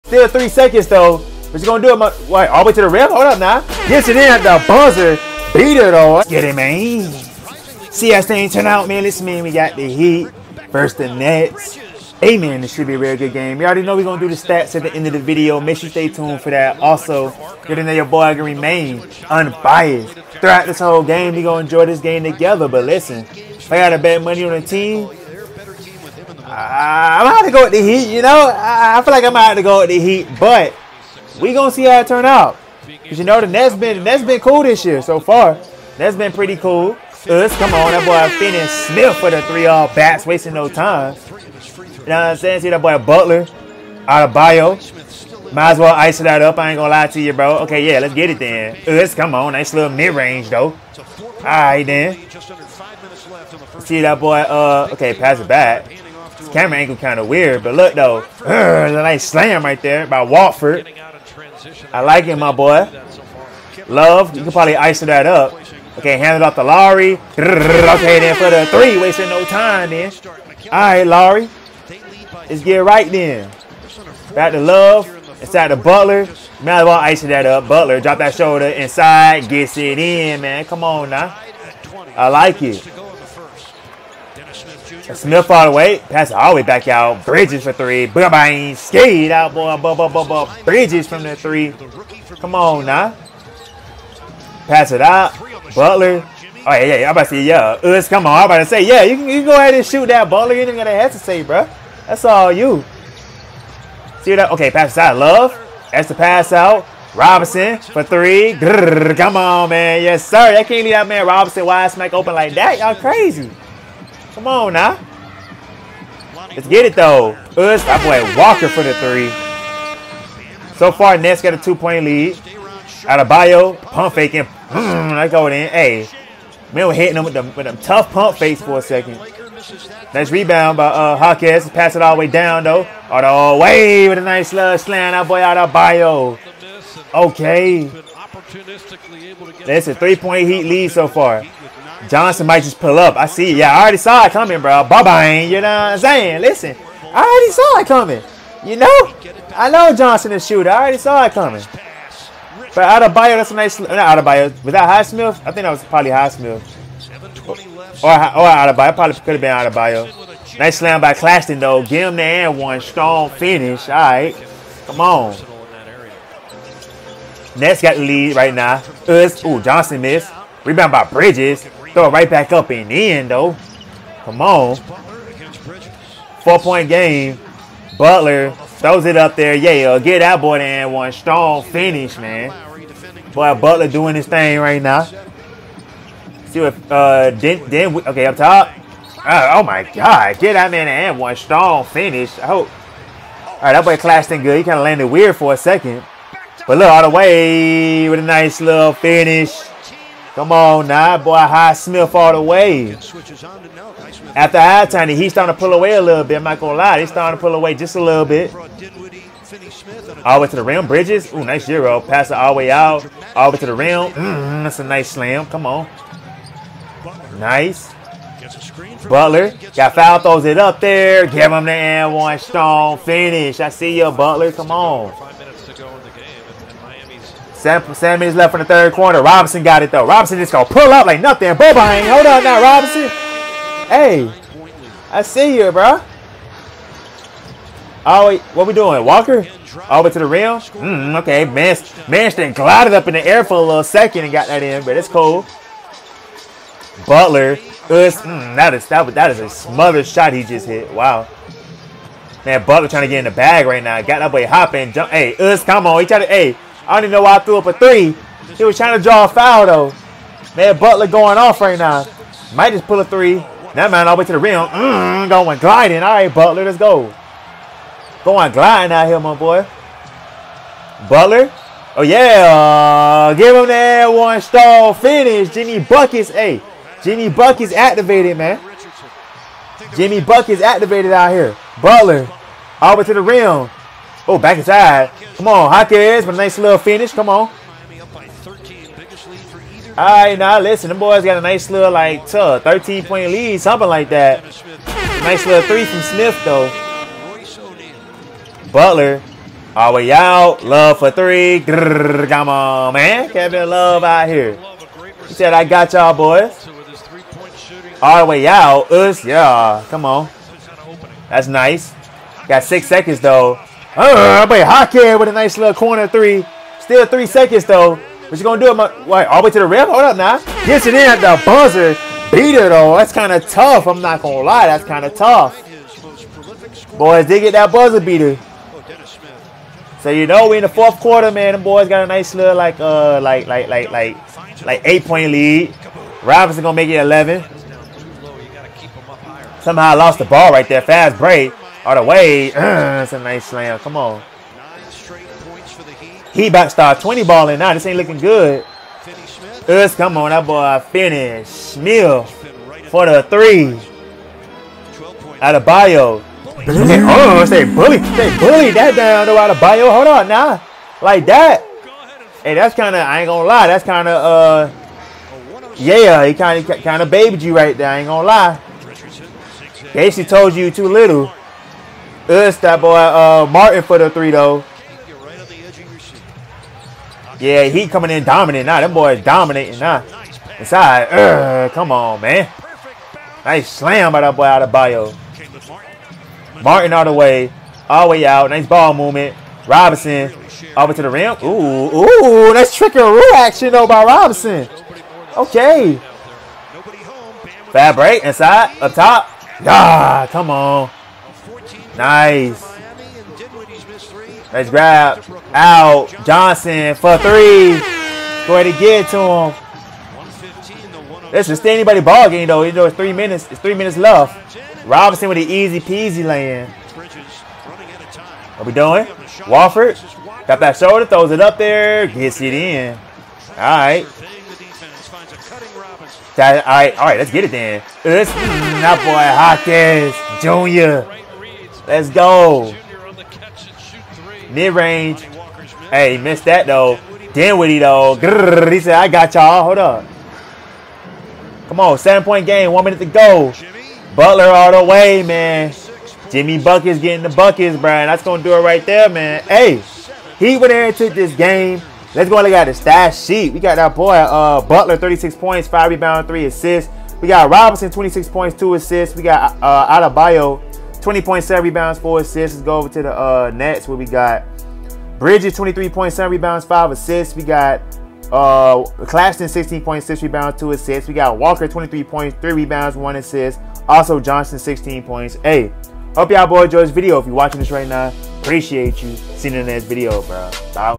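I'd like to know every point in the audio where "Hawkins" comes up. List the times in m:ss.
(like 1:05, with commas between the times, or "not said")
2:11, 4:45, 7:10.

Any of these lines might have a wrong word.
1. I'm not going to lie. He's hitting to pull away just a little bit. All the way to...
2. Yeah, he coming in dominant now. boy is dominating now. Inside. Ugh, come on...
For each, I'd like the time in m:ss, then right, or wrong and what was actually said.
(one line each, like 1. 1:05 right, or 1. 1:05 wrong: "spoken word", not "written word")
1. 3:26 wrong: "starting", not "hitting"
2. 6:17 right.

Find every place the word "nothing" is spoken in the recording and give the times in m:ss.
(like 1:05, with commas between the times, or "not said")
3:51.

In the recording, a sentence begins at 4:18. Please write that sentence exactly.
He was trying to draw a foul though.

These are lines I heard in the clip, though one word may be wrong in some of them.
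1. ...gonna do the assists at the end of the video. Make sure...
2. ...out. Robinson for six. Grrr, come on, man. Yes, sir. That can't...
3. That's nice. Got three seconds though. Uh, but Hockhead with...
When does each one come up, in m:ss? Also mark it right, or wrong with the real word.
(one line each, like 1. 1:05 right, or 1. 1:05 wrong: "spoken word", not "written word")
1. 0:14 wrong: "stats", not "assists"
2. 1:46 wrong: "three", not "six"
3. 5:11 wrong: "six", not "three".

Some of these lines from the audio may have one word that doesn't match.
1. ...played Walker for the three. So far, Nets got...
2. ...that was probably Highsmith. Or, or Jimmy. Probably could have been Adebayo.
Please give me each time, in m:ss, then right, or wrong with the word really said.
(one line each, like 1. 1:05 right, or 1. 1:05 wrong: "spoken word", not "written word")
1. 1:57 right
2. 2:35 wrong: "Adebayo", not "Jimmy".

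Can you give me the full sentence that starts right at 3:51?
Boba ain't hold on now, Robinson.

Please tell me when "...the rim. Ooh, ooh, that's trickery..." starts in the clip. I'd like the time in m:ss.
6:31.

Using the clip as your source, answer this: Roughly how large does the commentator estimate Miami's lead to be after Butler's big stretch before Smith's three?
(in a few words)
13 points.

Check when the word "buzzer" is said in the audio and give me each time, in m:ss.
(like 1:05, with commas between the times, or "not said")
0:04, 5:21, 5:27.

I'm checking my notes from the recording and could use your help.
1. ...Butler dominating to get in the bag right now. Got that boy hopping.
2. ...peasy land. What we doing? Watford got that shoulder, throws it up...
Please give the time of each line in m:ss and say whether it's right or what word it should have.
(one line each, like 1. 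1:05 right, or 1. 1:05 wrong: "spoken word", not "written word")
1. 4:12 wrong: "trying", not "dominating"
2. 6:55 right.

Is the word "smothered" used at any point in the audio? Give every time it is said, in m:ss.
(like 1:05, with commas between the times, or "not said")
4:09.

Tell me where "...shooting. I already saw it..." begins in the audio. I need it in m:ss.
2:30.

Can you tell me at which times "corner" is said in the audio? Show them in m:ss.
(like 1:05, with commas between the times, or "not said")
3:48, 5:15.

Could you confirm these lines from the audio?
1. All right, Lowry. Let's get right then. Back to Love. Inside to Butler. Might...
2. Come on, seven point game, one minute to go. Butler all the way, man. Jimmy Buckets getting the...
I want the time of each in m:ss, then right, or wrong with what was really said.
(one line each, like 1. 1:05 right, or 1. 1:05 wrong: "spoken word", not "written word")
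1. 1:10 right
2. 7:21 right.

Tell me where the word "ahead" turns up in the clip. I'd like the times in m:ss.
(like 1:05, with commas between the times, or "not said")
1:39, 6:48.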